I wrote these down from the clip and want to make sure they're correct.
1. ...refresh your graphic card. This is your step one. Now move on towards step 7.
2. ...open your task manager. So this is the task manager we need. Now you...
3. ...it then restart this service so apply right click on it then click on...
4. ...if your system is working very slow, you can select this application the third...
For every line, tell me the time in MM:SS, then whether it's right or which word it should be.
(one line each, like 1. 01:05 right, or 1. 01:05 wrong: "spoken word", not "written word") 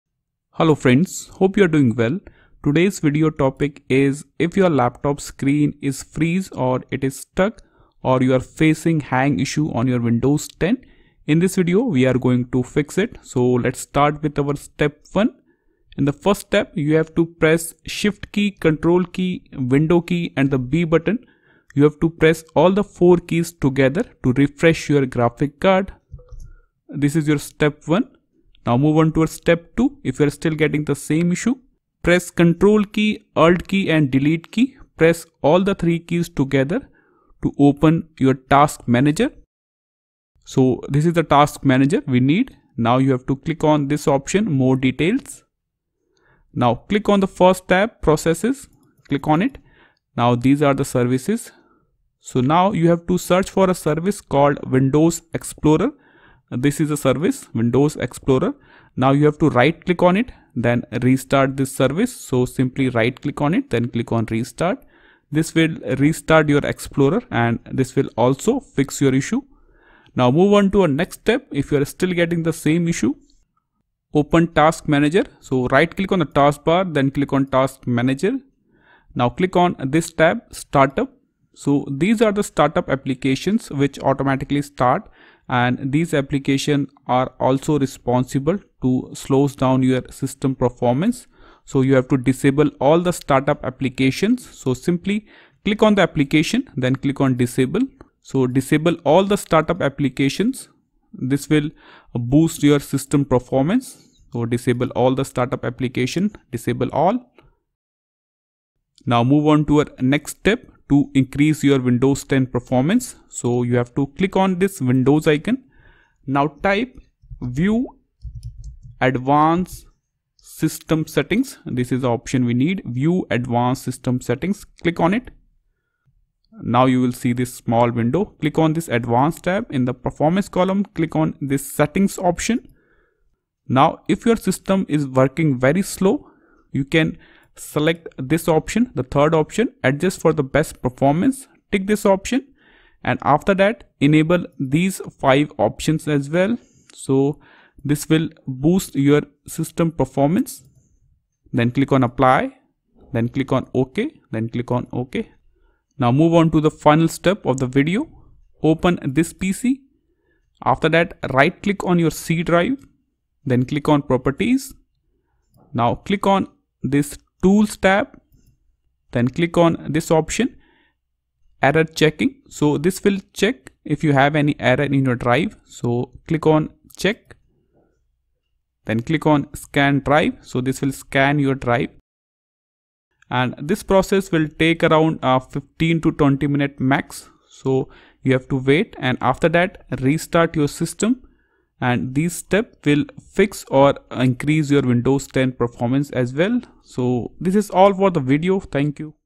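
1. 00:24 wrong: "2", not "7"
2. 00:37 right
3. 01:00 wrong: "simply", not "apply"
4. 02:14 wrong: "option", not "application".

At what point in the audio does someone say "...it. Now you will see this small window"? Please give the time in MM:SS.
02:05.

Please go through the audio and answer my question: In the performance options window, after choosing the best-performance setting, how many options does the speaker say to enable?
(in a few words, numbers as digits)
5.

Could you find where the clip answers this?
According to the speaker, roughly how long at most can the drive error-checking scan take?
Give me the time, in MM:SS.
03:05.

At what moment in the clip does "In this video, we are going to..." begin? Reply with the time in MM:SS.
00:11.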